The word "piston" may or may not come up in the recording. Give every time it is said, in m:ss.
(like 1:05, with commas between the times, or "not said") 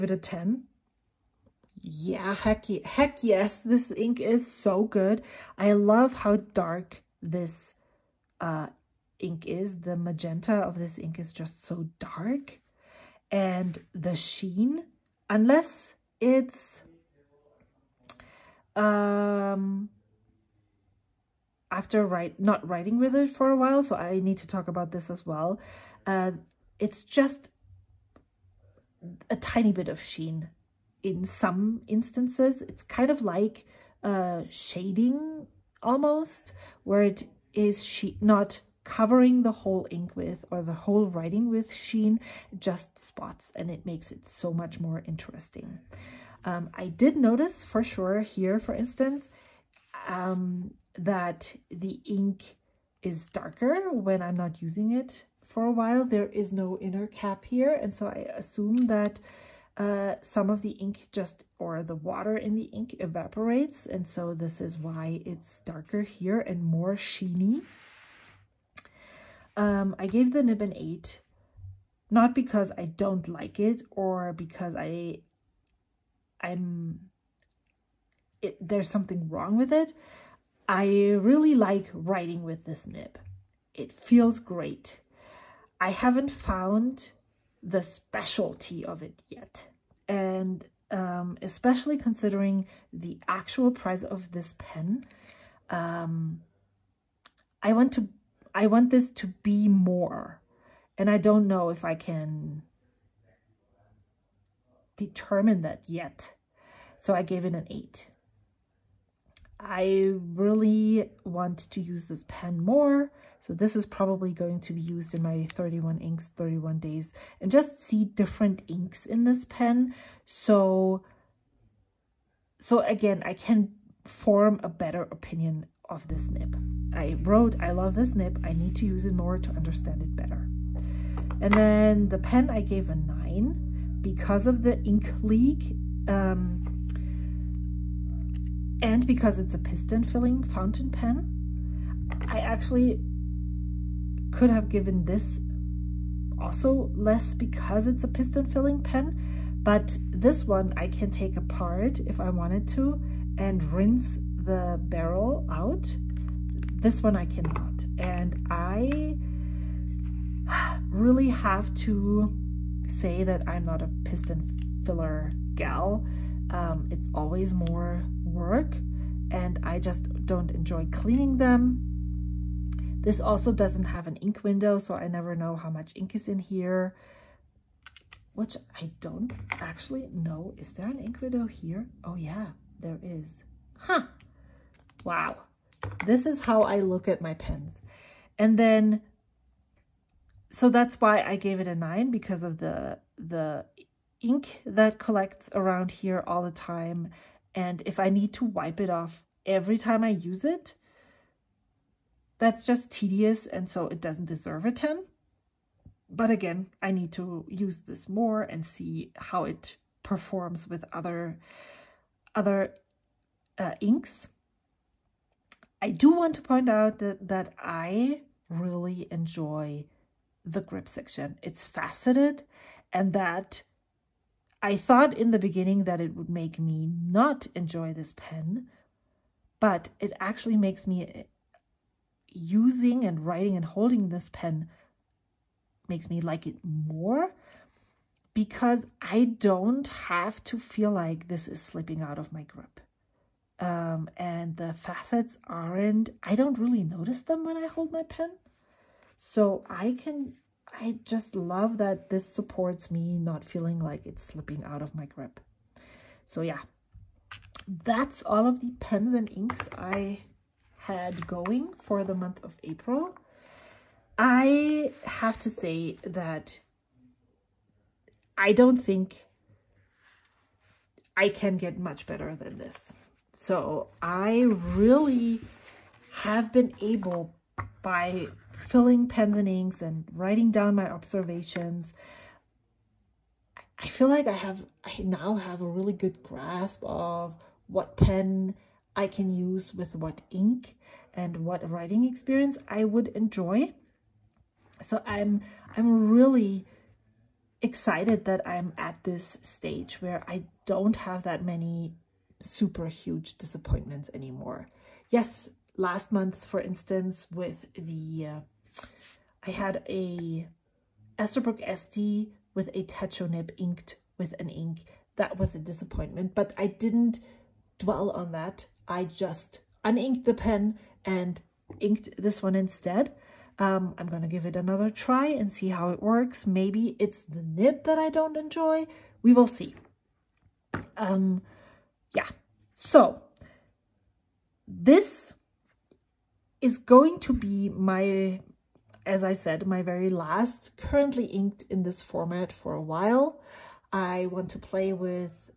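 2:19, 2:28, 2:44.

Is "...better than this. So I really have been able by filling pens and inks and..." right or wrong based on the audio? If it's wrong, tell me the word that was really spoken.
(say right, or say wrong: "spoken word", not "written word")
right.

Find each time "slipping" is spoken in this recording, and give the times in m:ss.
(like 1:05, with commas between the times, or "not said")
4:01, 4:14.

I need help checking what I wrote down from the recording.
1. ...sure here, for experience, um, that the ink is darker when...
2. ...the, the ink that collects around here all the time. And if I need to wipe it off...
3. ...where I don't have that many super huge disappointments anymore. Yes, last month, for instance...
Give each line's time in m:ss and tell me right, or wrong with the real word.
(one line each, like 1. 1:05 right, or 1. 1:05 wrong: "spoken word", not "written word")
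1. 0:47 wrong: "instance", not "experience"
2. 3:12 right
3. 5:00 right.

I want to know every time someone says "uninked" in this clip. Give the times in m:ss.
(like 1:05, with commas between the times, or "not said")
5:19.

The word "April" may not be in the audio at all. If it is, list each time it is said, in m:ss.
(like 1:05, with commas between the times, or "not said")
4:22.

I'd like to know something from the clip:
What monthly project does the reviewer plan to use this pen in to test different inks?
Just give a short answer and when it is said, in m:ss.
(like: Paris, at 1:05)
31 inks, 31 days, at 1:55.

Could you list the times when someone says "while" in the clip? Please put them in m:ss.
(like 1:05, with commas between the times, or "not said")
0:23, 0:55, 5:42.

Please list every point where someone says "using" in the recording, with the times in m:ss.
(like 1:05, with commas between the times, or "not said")
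0:54, 3:52.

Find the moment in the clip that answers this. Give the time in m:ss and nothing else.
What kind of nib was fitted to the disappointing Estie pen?
5:12.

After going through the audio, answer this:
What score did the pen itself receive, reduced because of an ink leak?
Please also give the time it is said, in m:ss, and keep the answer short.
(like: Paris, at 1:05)
9, at 2:12.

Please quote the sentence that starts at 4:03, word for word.
Um, and the facets aren't, I don't really notice them when I hold my pen.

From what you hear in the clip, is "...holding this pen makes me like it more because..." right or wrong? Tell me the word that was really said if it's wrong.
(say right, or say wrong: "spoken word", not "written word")
right.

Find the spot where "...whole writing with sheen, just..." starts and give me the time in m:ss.
0:40.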